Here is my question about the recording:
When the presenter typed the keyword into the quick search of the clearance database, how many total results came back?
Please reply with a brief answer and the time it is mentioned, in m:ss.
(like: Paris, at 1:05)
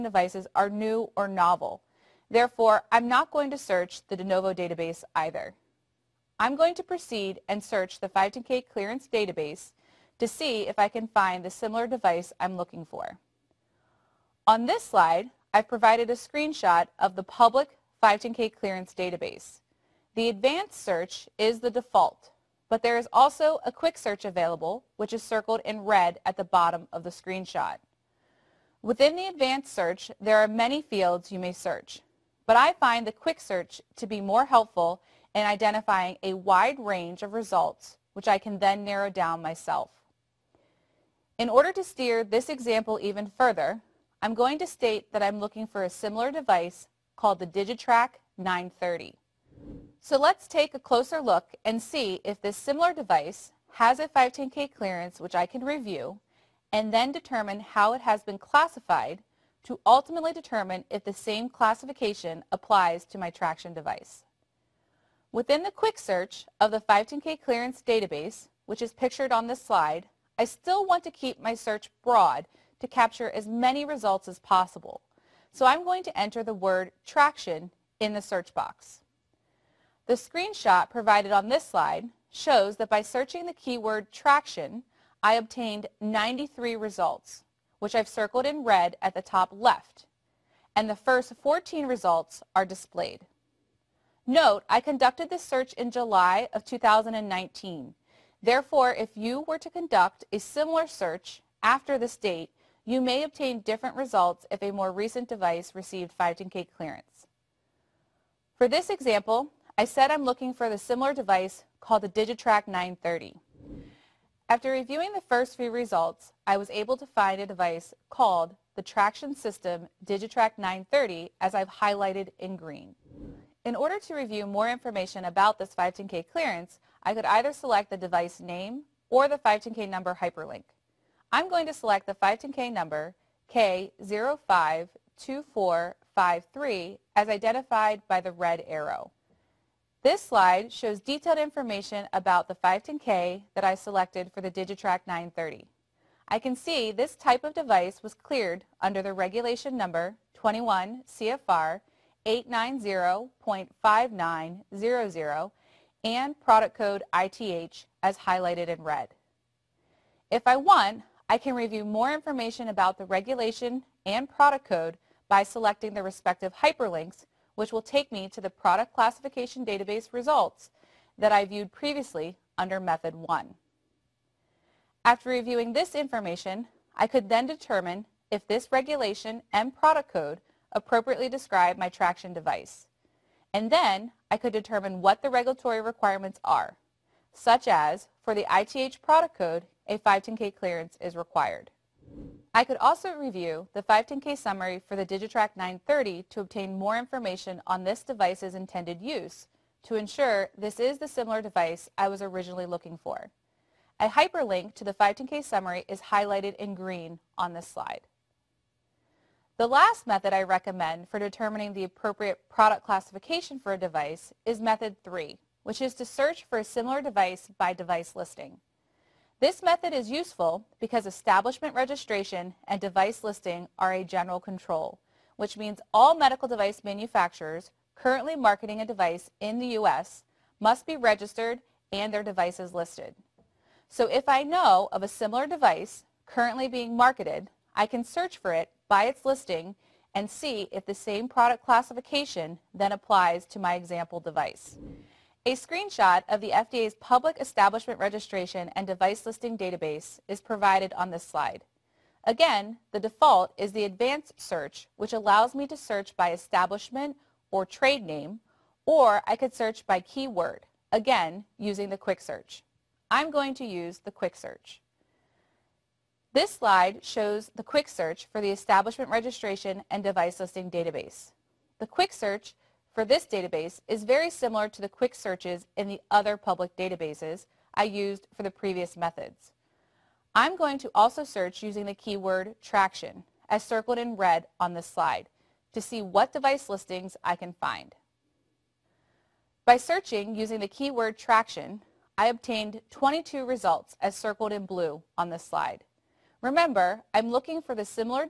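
93, at 1:26.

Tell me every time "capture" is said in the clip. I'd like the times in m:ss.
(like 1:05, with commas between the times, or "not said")
1:12.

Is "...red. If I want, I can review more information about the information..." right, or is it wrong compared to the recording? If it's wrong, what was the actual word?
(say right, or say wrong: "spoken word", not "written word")
wrong: "regulation", not "information".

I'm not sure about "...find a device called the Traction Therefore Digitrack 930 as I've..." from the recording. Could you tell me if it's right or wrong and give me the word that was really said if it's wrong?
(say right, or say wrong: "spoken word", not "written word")
wrong: "System", not "Therefore".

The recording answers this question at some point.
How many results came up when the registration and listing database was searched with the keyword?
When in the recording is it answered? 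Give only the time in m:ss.
4:52.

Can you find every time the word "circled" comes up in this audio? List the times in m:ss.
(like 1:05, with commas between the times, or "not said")
0:25, 1:28, 4:43, 4:54.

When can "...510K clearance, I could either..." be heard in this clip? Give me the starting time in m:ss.
2:05.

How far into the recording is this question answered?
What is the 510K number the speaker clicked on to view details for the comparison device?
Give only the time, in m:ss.
2:13.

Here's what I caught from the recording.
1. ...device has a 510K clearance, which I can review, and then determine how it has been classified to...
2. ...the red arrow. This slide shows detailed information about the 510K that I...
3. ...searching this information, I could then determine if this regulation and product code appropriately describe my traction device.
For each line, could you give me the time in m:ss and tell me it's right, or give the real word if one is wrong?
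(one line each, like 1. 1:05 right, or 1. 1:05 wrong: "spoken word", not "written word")
1. 0:52 right
2. 2:18 right
3. 2:55 wrong: "reviewing", not "searching".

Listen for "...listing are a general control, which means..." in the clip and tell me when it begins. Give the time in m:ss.
3:43.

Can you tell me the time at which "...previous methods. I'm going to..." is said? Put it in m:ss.
4:38.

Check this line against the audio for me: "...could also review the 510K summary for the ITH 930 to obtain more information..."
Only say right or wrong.
wrong.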